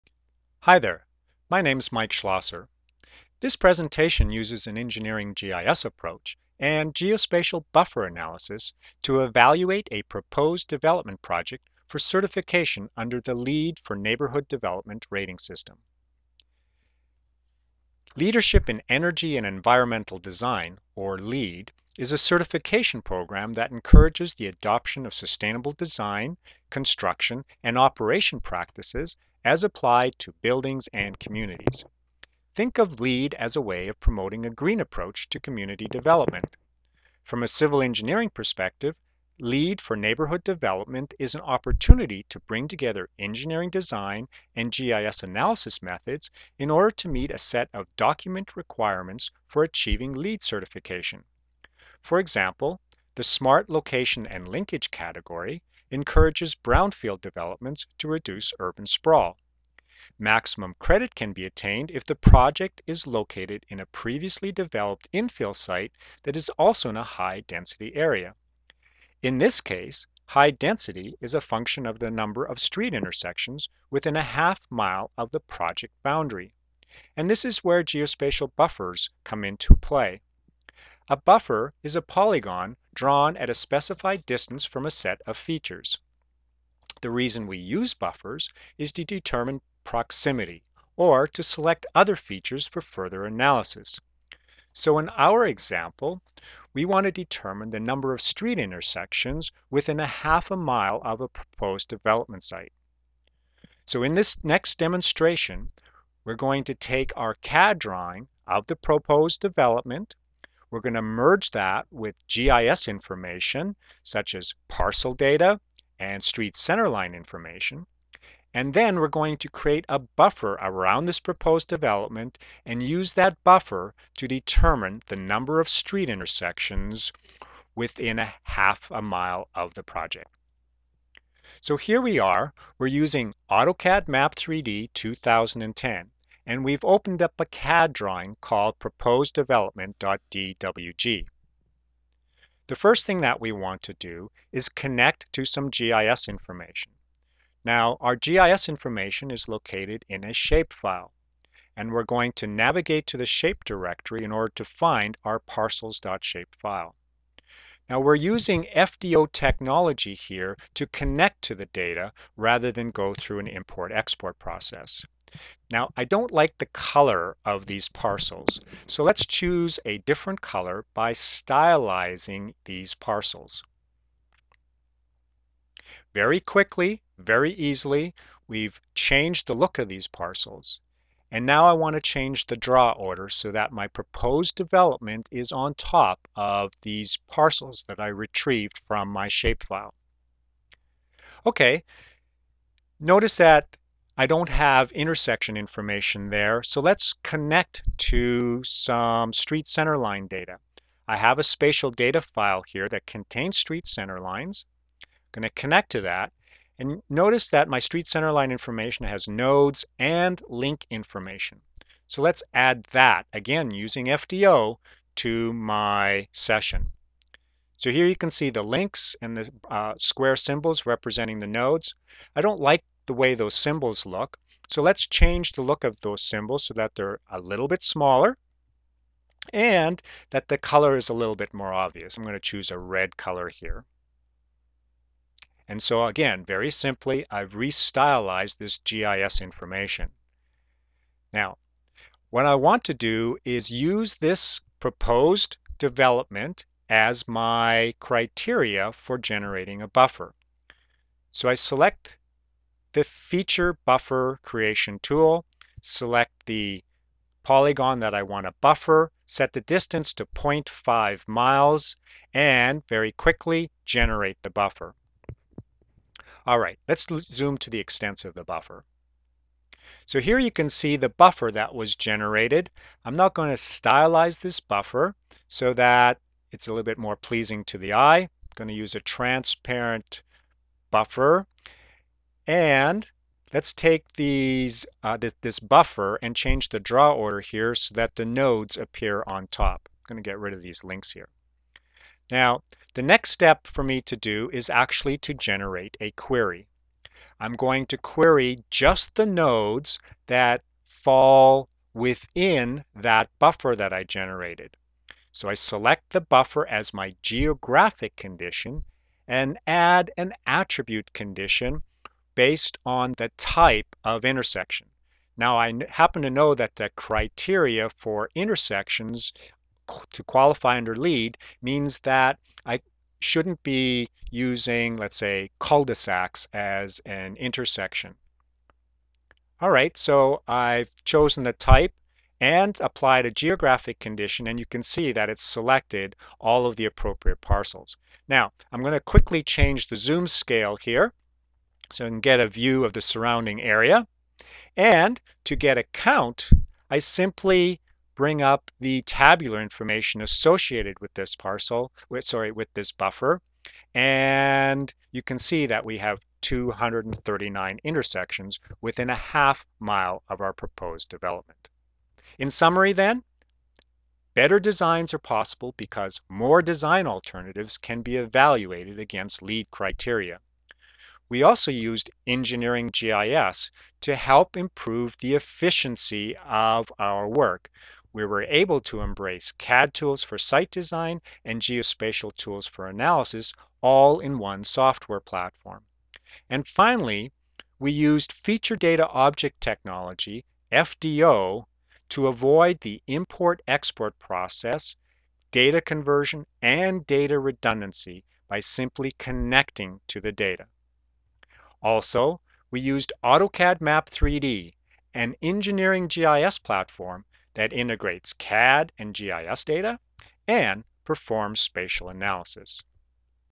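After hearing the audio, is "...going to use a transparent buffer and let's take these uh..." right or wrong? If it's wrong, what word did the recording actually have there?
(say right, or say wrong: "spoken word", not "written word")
right.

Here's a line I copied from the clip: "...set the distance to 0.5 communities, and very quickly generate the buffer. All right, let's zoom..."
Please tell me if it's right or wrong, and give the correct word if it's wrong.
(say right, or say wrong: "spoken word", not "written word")
wrong: "miles", not "communities".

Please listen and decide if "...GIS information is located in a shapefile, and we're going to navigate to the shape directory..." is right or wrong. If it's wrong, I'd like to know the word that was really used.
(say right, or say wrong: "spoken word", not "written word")
right.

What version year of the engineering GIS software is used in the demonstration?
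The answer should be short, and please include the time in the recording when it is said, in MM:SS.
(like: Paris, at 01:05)
2010, at 02:14.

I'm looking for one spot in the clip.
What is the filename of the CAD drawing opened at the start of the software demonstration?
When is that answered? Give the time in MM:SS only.
02:18.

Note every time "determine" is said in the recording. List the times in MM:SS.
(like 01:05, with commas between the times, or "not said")
01:29, 01:37, 02:04.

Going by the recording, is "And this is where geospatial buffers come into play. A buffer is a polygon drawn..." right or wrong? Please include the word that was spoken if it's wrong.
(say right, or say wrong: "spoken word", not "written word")
right.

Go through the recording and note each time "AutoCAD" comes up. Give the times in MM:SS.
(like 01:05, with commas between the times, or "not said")
02:13, 06:43.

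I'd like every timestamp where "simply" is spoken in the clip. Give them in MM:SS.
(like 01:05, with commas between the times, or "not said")
03:56, 05:46, 06:38.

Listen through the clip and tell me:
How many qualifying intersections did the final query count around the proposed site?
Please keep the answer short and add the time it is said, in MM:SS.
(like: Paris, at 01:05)
239, at 05:56.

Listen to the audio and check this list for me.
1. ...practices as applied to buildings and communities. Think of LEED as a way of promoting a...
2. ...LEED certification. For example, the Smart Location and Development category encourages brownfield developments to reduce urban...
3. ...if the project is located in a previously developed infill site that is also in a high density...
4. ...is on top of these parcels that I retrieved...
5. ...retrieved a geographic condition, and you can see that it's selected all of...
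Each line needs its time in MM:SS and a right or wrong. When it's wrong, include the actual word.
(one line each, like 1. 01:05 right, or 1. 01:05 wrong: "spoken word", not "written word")
1. 00:28 right
2. 00:50 wrong: "Linkage", not "Development"
3. 01:01 right
4. 03:05 right
5. 05:32 wrong: "applied", not "retrieved".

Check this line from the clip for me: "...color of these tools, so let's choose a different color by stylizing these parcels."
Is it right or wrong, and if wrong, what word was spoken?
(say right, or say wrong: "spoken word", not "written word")
wrong: "parcels", not "tools".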